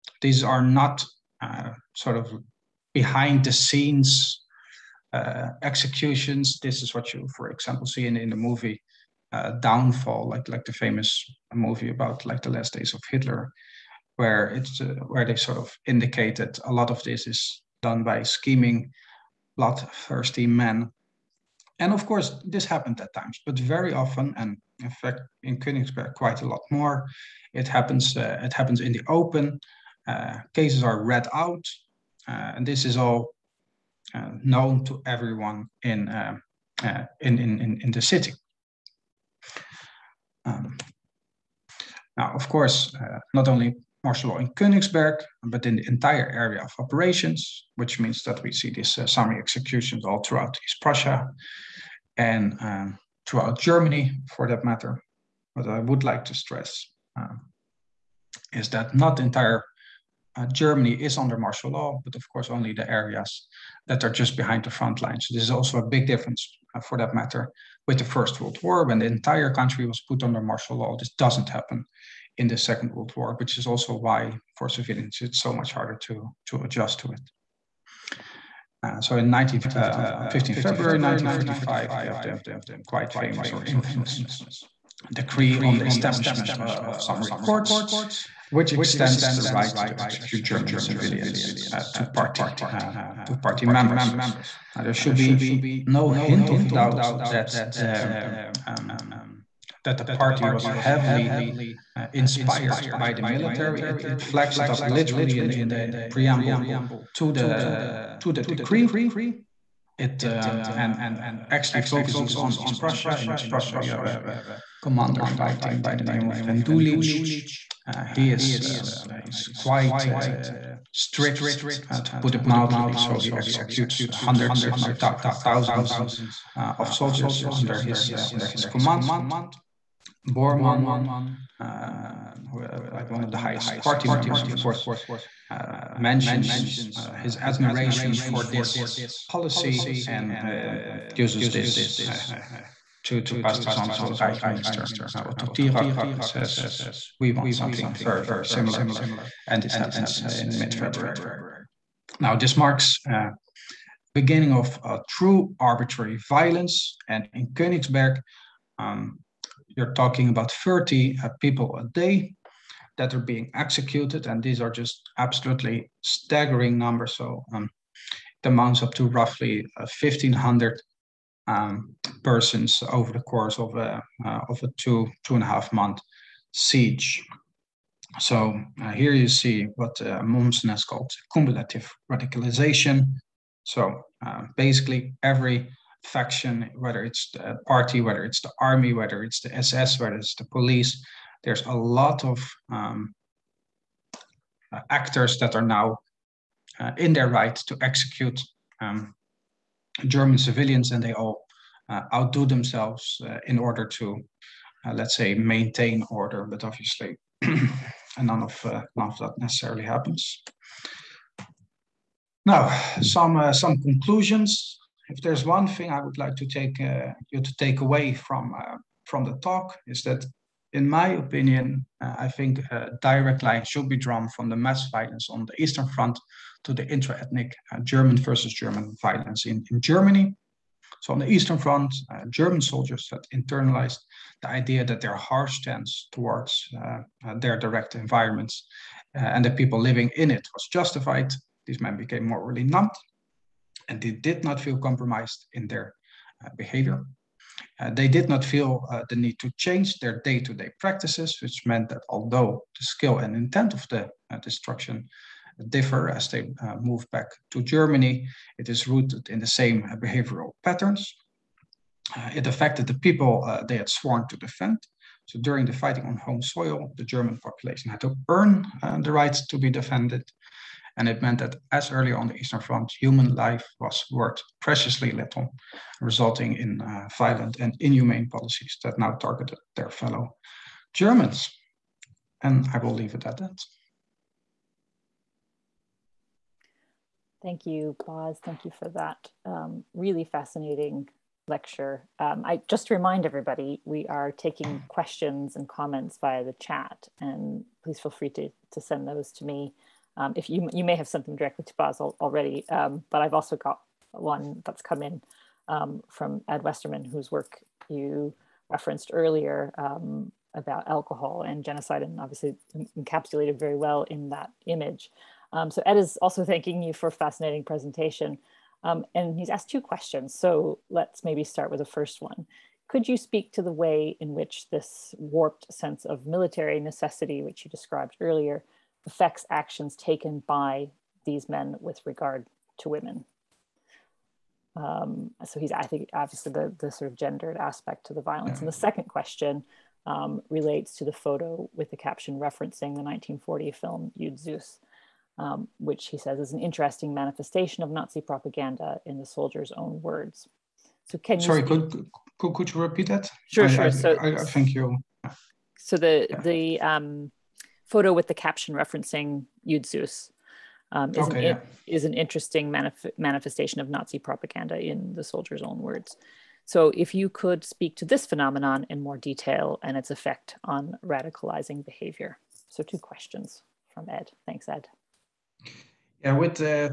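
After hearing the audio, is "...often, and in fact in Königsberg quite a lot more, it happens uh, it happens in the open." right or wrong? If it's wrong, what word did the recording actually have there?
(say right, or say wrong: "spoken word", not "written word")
right.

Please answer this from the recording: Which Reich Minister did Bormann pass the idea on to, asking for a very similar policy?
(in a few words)
Otto Thierack.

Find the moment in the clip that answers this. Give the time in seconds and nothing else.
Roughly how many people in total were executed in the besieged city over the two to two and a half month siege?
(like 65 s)
169 s.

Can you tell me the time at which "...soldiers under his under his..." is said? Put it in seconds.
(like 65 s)
126 s.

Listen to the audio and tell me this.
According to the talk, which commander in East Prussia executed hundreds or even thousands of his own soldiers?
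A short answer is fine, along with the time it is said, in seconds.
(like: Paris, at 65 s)
Rendulic, at 116 s.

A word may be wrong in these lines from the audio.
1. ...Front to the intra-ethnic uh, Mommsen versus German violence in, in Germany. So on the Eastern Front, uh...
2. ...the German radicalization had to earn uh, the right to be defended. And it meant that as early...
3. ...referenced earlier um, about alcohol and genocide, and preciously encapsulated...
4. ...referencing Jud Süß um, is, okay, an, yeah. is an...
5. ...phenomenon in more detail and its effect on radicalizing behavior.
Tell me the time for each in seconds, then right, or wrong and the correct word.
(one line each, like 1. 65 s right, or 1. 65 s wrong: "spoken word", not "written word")
1. 225 s wrong: "German", not "Mommsen"
2. 266 s wrong: "population", not "radicalization"
3. 308 s wrong: "obviously", not "preciously"
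4. 358 s right
5. 368 s right.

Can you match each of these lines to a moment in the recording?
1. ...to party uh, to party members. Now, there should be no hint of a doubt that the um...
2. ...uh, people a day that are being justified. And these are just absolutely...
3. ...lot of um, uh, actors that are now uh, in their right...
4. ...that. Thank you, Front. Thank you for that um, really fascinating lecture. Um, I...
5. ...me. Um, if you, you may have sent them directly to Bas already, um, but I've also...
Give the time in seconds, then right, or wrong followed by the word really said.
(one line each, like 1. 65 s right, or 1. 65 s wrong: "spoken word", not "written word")
1. 91 s right
2. 161 s wrong: "executed", not "justified"
3. 191 s right
4. 283 s wrong: "Bas", not "Front"
5. 299 s right.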